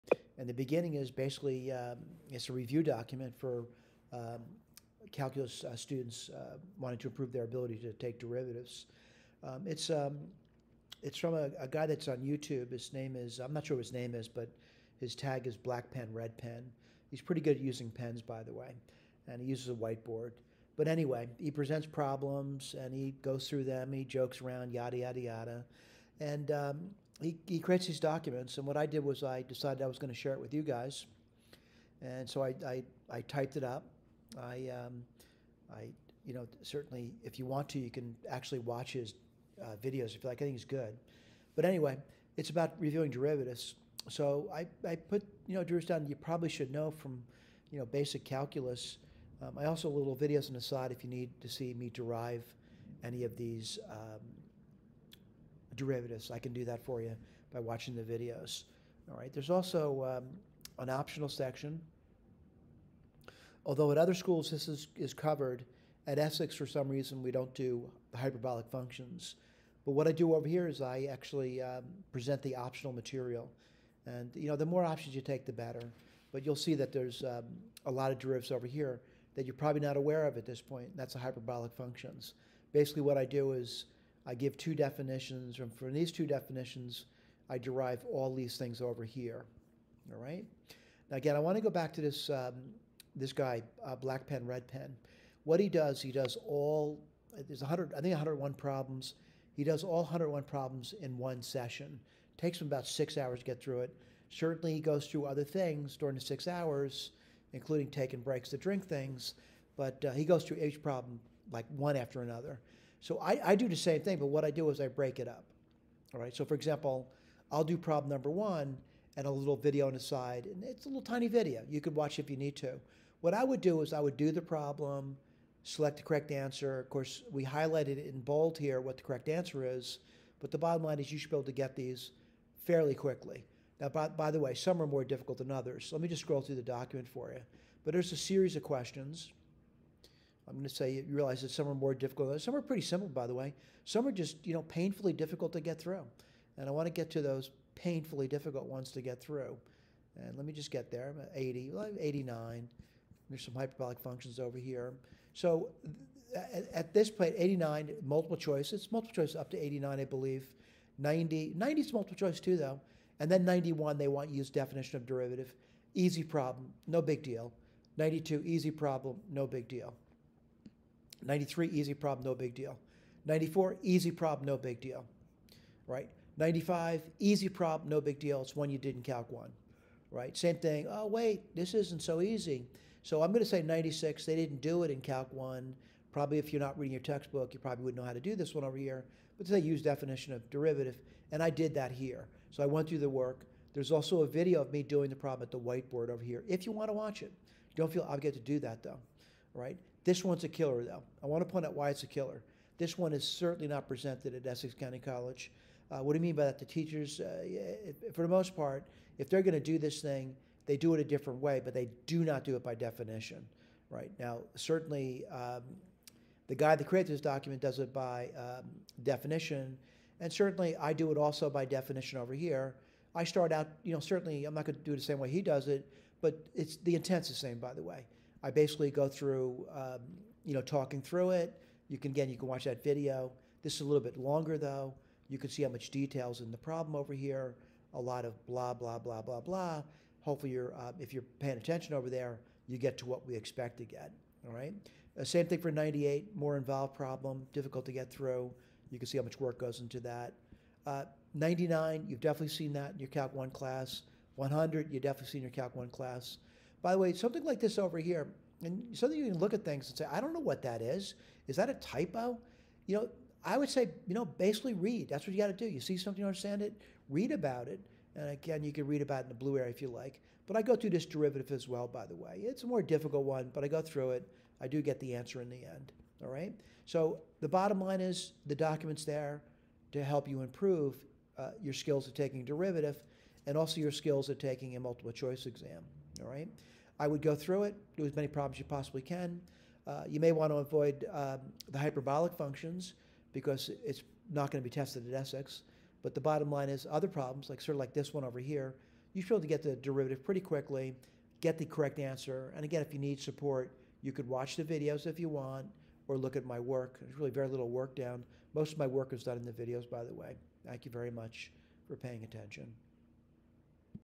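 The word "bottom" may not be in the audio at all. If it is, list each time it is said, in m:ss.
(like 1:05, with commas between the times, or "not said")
2:10, 4:37, 4:56.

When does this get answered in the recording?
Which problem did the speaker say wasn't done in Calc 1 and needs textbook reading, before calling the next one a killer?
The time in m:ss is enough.
3:03.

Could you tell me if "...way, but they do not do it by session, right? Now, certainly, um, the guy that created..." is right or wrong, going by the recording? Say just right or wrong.
wrong.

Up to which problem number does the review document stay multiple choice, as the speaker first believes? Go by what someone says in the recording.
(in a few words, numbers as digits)
89.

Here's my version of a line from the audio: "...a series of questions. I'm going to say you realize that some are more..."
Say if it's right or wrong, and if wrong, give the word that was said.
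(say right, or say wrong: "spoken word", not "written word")
right.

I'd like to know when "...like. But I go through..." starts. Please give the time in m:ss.
4:29.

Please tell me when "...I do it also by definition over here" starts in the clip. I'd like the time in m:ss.
3:40.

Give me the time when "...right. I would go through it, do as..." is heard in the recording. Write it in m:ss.
4:46.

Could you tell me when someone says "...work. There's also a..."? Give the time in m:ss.
3:13.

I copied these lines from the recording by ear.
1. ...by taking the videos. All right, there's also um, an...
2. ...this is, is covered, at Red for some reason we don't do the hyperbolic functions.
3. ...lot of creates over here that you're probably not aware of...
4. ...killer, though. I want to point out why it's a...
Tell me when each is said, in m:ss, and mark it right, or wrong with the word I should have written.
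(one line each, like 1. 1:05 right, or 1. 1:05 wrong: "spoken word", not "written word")
1. 0:57 wrong: "watching", not "taking"
2. 1:04 wrong: "Essex", not "Red"
3. 1:17 wrong: "derivatives", not "creates"
4. 3:20 right.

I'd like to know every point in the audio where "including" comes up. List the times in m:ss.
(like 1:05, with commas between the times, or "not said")
1:47.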